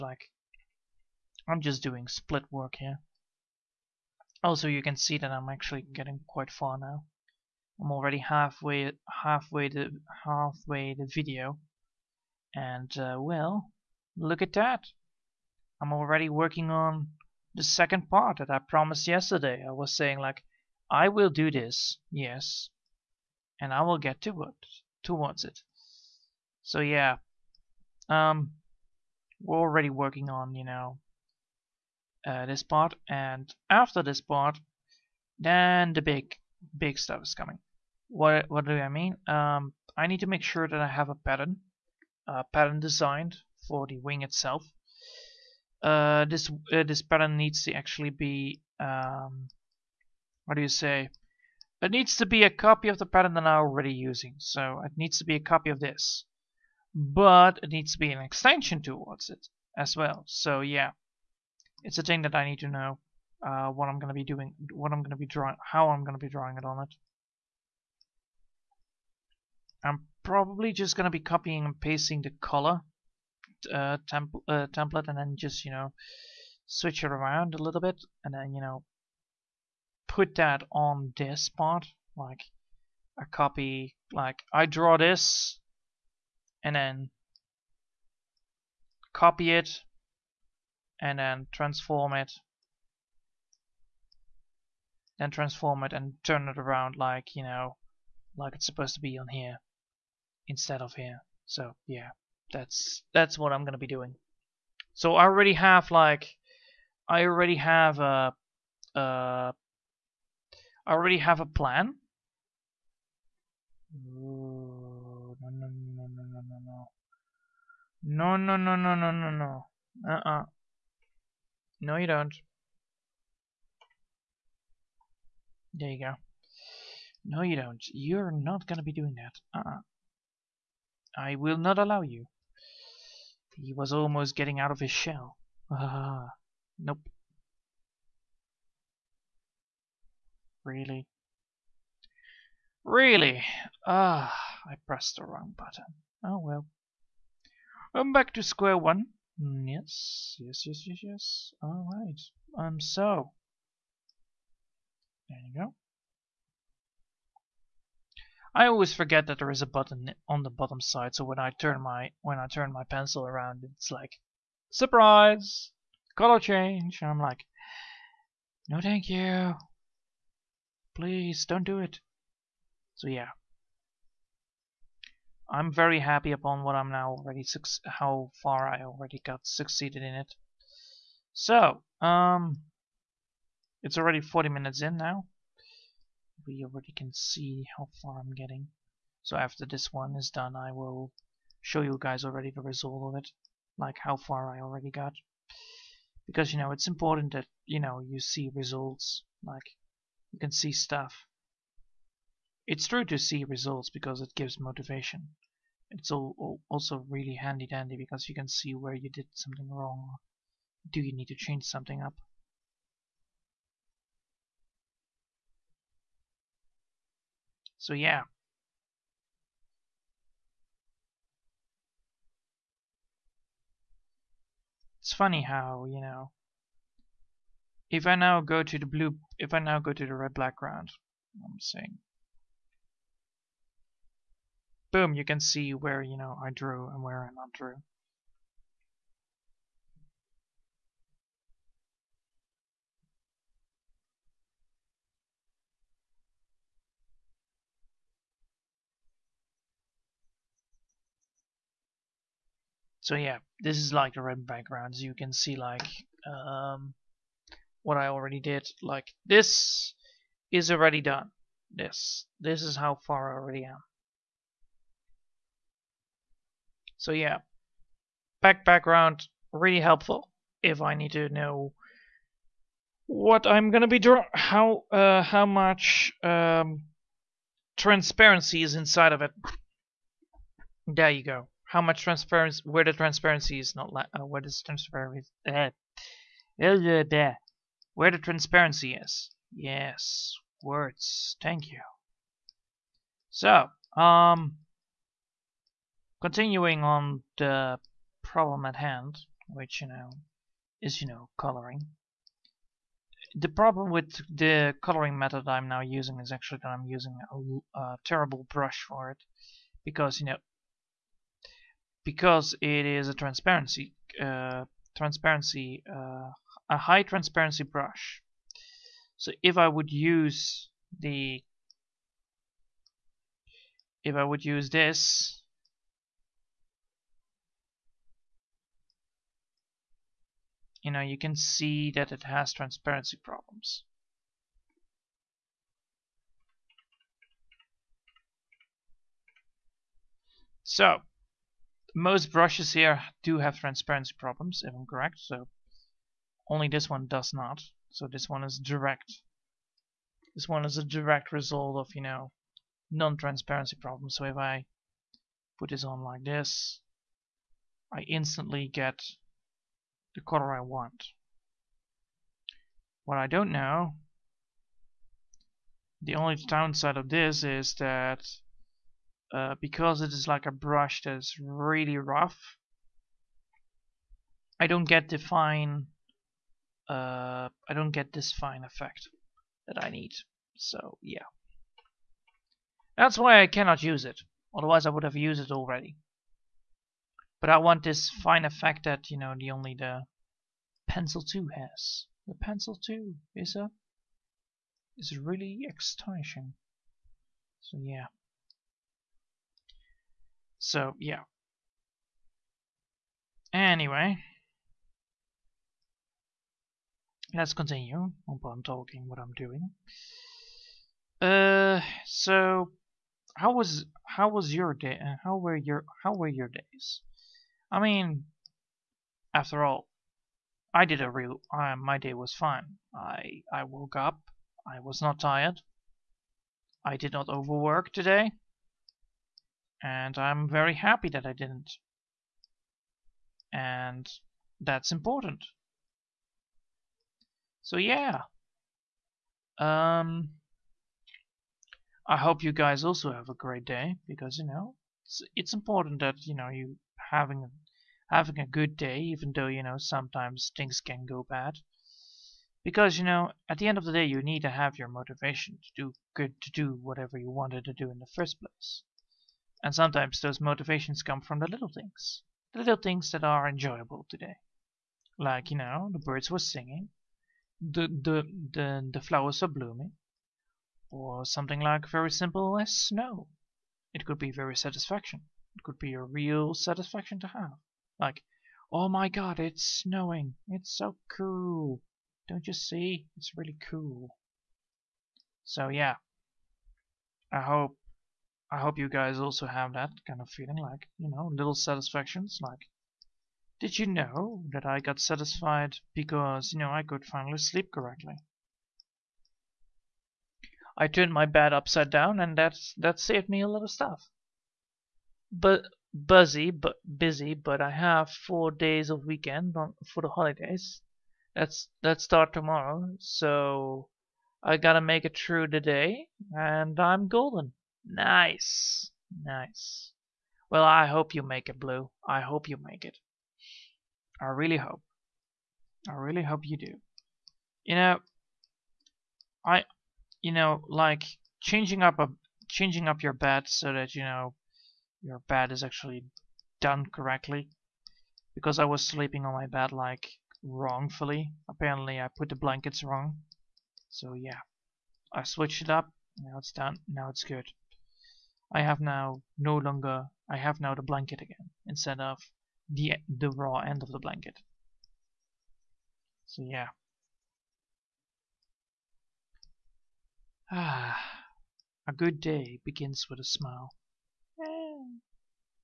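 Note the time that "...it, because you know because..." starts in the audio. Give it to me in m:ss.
5:09.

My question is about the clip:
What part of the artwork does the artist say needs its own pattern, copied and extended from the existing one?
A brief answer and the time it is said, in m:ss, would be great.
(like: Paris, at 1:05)
The wing, at 0:43.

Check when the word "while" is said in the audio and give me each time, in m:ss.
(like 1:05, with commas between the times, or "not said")
6:48.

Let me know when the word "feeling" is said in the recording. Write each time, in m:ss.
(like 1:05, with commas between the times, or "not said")
8:10.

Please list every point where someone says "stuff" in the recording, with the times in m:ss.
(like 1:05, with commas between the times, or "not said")
0:36, 3:20, 8:23.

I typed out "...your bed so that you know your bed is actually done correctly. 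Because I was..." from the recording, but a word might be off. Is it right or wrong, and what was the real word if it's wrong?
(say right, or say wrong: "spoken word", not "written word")
right.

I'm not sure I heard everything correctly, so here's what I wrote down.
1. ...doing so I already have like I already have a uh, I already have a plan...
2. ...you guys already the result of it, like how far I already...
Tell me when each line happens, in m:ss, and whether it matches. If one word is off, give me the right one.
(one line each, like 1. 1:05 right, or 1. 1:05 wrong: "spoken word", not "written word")
1. 1:43 right
2. 3:11 right.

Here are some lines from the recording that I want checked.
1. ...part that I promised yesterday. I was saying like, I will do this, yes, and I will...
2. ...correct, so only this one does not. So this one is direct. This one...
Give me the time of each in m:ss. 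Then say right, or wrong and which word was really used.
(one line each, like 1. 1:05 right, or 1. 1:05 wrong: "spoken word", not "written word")
1. 0:18 right
2. 5:44 right.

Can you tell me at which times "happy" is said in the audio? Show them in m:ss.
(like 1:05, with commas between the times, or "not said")
2:55, 7:10.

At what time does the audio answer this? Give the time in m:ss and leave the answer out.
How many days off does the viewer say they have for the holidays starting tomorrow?
8:28.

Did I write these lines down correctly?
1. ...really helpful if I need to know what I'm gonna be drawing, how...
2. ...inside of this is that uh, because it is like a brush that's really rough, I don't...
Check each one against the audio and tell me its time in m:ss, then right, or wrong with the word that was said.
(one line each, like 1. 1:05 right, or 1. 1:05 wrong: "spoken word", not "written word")
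1. 4:29 right
2. 6:06 wrong: "downside", not "inside".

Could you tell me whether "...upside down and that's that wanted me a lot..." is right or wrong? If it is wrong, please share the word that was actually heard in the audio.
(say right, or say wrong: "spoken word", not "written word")
wrong: "saved", not "wanted".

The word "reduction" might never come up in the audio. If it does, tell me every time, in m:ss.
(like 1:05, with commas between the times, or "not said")
not said.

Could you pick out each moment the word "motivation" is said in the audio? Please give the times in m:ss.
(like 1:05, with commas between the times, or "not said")
3:24, 7:34, 7:40.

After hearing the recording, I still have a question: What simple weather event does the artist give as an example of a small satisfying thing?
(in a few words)
Snow.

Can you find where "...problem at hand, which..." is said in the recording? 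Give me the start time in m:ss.
4:58.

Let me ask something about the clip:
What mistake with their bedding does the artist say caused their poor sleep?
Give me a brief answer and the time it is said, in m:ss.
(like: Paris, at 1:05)
Put the blankets wrong, at 9:02.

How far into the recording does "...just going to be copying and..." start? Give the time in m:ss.
1:10.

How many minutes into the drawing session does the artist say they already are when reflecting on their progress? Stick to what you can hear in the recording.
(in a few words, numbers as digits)
40.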